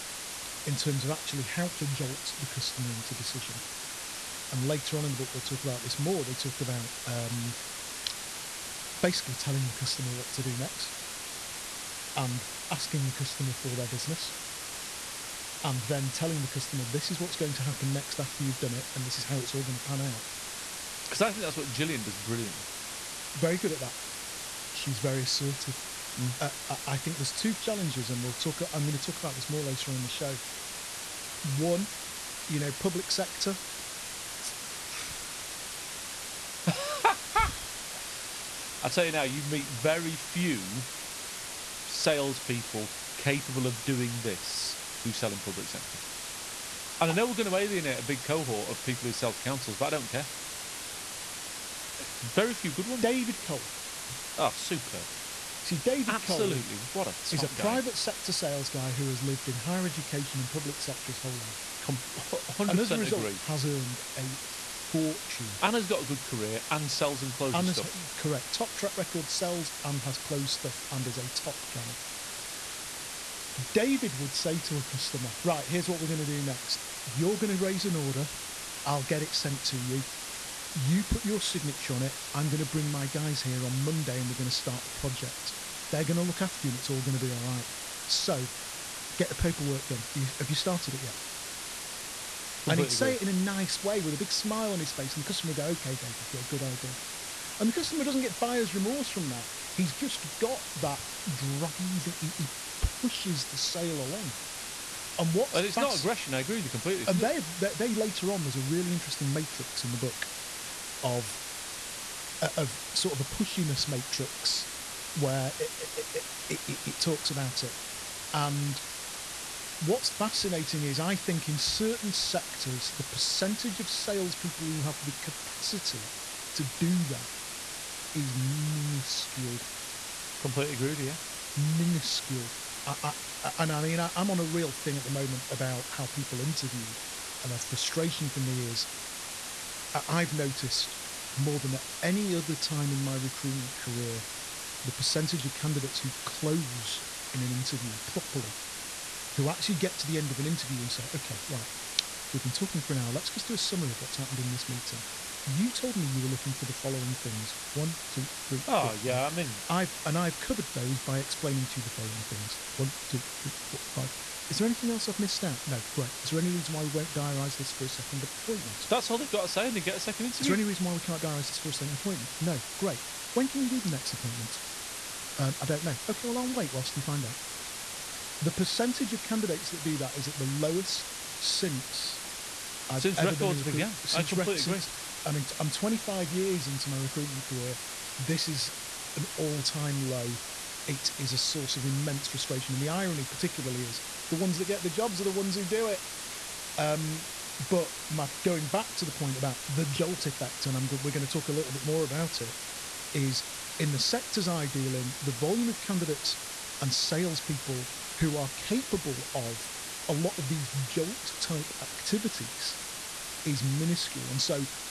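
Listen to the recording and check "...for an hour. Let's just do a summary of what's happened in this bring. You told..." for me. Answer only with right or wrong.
wrong.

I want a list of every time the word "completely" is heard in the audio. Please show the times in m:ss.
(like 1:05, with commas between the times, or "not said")
1:32, 1:46, 2:10, 3:04.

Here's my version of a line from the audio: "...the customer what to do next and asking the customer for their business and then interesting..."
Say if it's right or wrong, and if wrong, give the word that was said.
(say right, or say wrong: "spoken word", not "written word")
wrong: "telling", not "interesting".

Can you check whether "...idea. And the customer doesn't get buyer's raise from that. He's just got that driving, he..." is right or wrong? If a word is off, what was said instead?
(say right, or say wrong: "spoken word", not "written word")
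wrong: "remorse", not "raise".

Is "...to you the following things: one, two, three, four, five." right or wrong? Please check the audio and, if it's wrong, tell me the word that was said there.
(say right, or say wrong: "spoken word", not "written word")
right.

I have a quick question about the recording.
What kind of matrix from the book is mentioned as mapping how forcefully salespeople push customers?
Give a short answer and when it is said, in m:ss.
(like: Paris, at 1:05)
Pushiness matrix, at 1:53.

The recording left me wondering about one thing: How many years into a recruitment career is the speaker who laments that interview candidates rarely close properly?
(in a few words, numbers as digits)
25.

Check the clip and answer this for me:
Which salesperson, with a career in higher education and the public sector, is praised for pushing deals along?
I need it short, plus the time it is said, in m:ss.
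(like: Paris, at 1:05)
David Cole, at 0:53.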